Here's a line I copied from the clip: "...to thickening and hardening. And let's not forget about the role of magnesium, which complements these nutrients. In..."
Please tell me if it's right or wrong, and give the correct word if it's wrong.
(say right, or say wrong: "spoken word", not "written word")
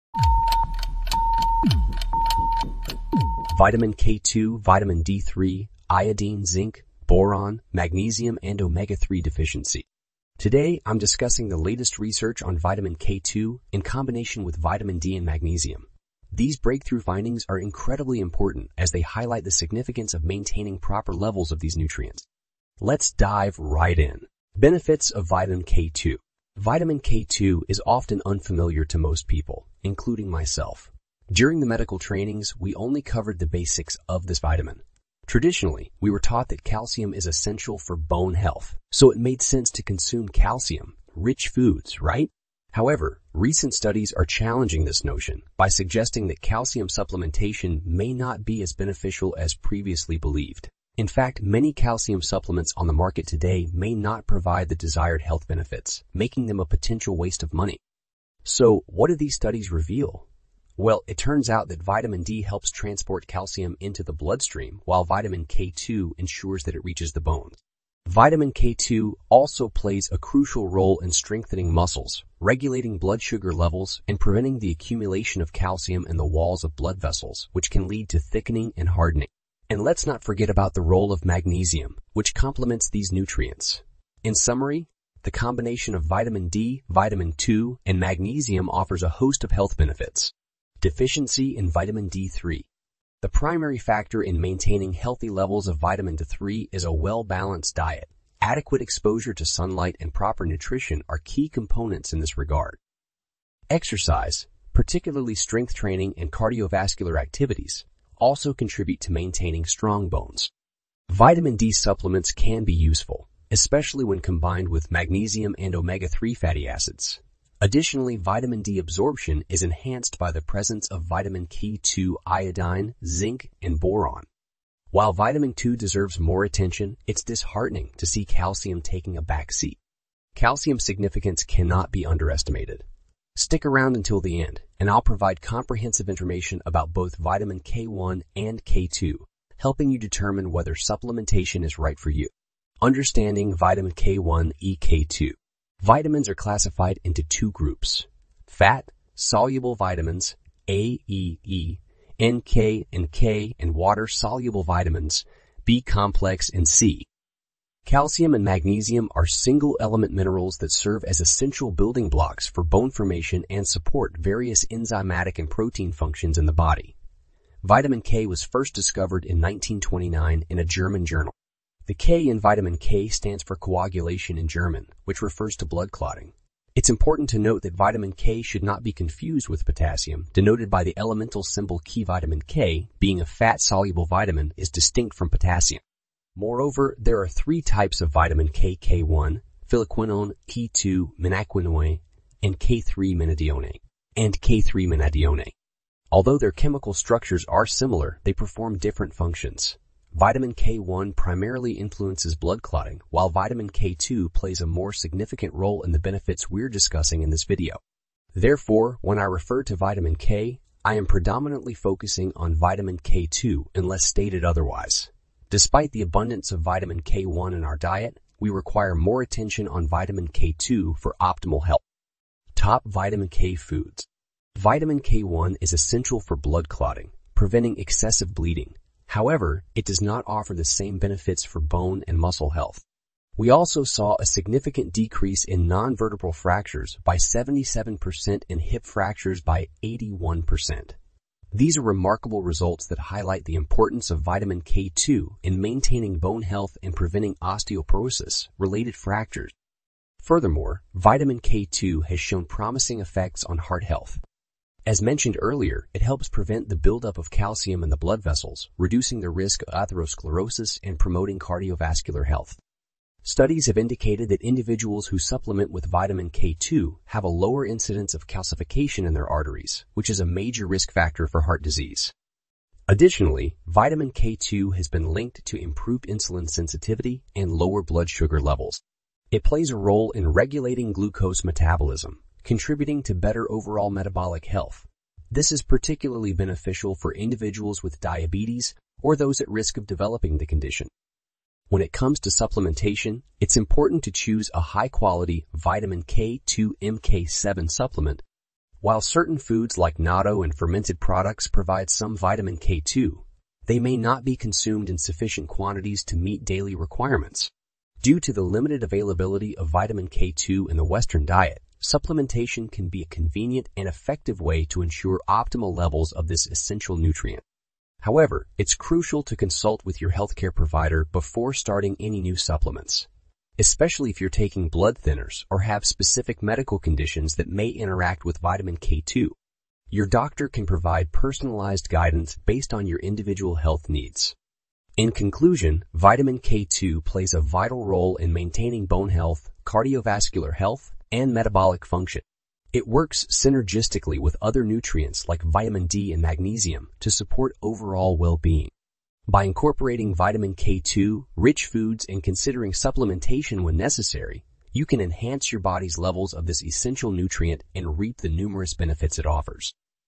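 right.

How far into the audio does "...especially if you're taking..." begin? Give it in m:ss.
5:23.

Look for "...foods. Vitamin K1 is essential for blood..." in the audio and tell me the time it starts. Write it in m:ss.
3:43.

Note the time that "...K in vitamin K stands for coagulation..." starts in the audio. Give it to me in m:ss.
2:51.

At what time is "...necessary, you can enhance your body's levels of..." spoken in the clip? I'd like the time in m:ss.
5:53.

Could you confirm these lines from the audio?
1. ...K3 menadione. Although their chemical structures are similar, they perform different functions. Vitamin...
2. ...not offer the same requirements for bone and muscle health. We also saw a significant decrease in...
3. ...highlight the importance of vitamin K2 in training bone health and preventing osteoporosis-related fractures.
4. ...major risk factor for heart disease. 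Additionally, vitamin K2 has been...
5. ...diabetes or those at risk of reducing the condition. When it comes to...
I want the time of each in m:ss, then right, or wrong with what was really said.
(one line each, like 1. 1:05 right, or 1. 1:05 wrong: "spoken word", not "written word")
1. 3:14 right
2. 3:49 wrong: "benefits", not "requirements"
3. 4:03 wrong: "maintaining", not "training"
4. 4:30 right
5. 4:47 wrong: "developing", not "reducing".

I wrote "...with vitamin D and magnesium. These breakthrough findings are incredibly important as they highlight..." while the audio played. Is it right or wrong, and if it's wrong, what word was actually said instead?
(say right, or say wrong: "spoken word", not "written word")
right.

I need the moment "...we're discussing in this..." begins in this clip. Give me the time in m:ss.
3:26.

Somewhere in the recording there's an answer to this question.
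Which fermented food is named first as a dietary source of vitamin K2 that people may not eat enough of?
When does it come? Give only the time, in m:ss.
4:59.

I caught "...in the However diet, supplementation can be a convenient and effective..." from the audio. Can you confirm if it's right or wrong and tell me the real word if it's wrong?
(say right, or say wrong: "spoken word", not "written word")
wrong: "Western", not "However".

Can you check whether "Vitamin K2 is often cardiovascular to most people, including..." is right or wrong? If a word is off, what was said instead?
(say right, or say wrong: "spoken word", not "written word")
wrong: "unfamiliar", not "cardiovascular".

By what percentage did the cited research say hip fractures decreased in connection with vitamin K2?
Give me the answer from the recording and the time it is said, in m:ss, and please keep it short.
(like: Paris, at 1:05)
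81%, at 3:59.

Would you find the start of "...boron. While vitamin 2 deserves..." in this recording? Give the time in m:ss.
2:03.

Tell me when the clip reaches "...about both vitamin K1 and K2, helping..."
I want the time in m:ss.
2:16.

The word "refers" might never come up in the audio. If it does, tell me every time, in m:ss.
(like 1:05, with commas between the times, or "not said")
2:55, 3:29.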